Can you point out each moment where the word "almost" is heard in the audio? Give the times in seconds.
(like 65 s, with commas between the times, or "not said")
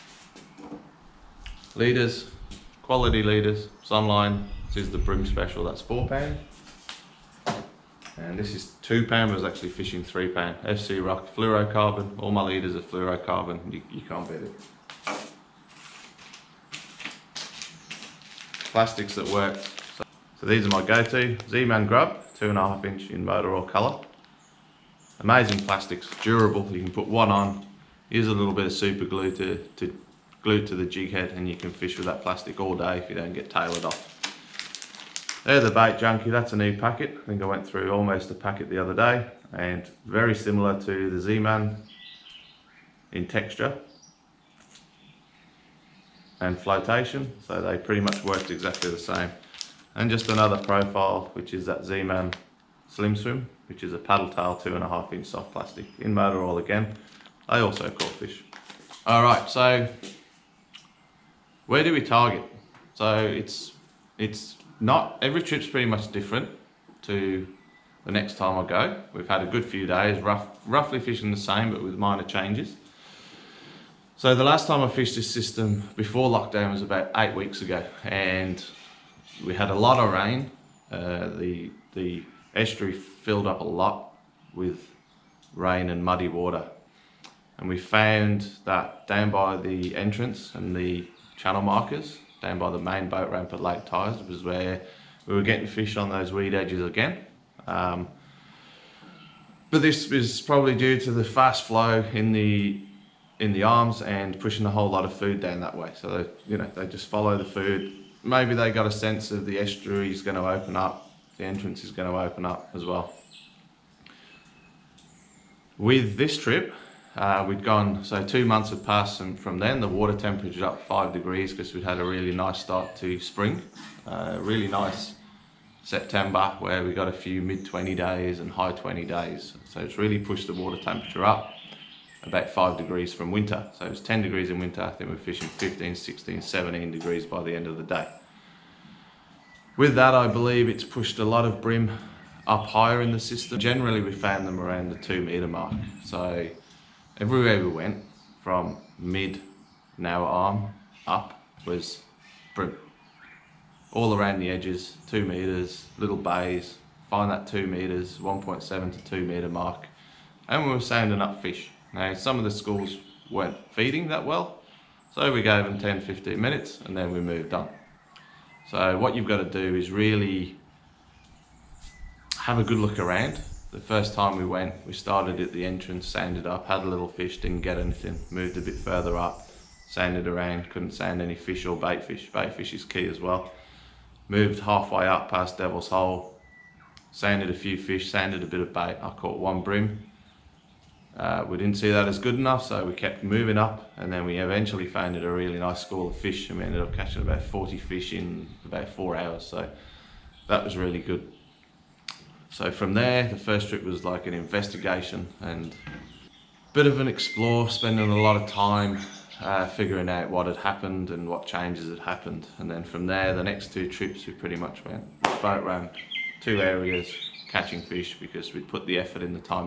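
37 s.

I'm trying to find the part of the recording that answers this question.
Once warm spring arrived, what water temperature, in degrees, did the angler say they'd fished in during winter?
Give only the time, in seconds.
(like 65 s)
134 s.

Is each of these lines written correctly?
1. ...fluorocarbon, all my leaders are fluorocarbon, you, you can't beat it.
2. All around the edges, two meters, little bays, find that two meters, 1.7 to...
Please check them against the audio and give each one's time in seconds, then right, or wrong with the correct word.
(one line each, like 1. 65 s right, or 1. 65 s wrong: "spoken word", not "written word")
1. 11 s right
2. 153 s right.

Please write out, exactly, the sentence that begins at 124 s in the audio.
Uh, really nice September where we got a few mid 20 days and high 20 days.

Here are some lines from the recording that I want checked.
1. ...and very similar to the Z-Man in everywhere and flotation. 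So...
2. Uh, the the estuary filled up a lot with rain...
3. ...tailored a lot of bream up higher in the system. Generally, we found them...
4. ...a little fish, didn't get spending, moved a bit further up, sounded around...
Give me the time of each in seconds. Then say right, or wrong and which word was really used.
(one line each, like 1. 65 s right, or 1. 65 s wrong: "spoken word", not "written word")
1. 39 s wrong: "texture", not "everywhere"
2. 80 s right
3. 140 s wrong: "pushed", not "tailored"
4. 176 s wrong: "anything", not "spending".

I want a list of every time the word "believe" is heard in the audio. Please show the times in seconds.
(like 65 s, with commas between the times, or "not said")
140 s.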